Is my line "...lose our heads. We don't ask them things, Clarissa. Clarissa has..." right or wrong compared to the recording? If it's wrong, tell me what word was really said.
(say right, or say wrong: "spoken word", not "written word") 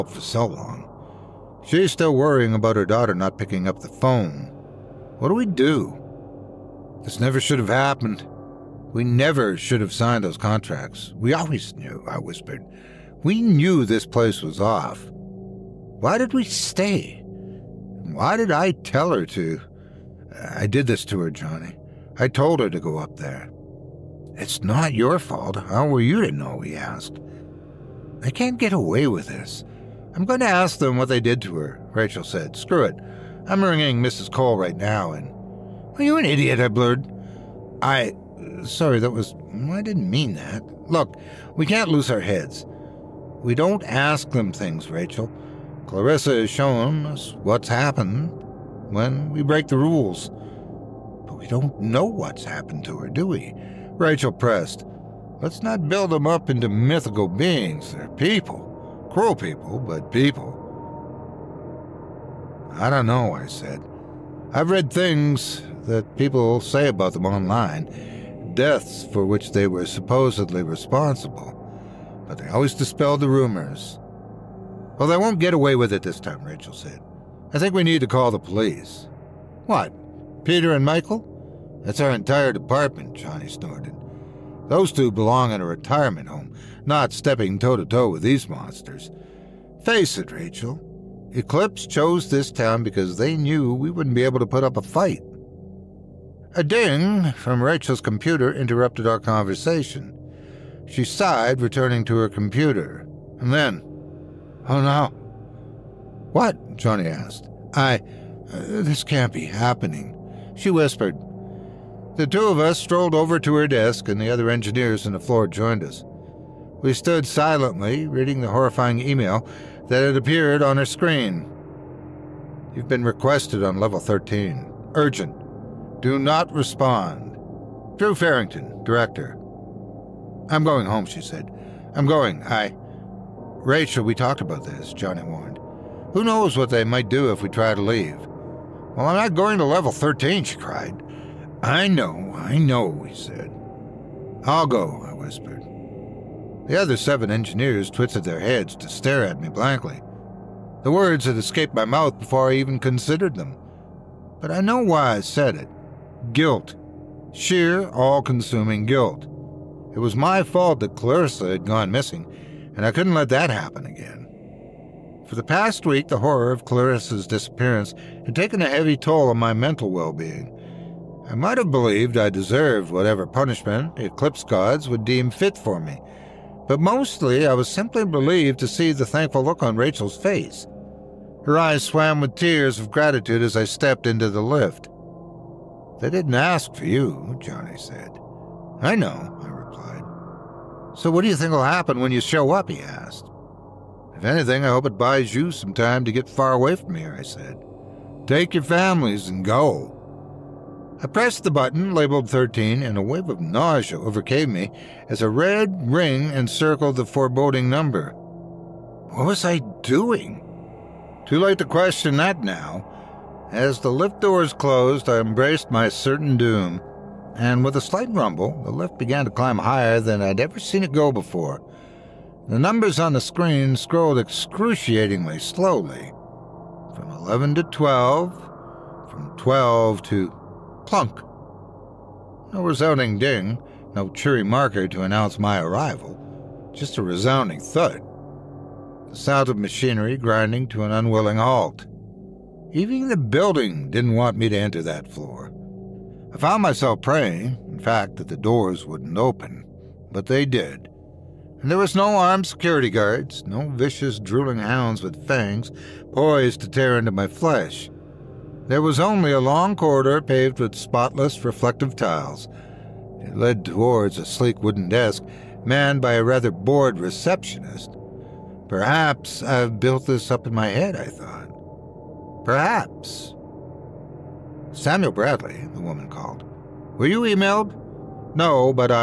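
wrong: "Rachel", not "Clarissa".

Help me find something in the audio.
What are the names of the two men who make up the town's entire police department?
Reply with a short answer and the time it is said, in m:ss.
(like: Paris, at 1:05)
Peter and Michael, at 1:20.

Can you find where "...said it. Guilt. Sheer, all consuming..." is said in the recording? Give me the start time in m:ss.
2:35.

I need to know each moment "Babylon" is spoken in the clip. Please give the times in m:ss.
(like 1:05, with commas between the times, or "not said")
not said.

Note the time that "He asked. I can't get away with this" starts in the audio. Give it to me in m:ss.
0:26.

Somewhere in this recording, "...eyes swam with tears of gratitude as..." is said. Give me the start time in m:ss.
3:01.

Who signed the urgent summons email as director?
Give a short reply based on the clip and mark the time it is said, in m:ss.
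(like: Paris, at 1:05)
Drew Farrington, at 2:07.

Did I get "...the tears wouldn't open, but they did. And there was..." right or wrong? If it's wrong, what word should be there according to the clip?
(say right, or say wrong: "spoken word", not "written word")
wrong: "doors", not "tears".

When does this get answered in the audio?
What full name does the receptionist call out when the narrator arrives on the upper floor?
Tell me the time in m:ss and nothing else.
4:34.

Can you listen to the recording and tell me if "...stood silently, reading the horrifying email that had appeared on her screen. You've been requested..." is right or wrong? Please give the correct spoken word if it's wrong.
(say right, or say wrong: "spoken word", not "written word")
right.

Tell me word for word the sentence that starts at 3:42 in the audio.
The numbers on the screen scrolled excruciatingly slowly from 11 to 12, from 12 to plunk.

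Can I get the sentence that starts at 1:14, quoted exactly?
Well, they won't get away with it this time, Rachel said.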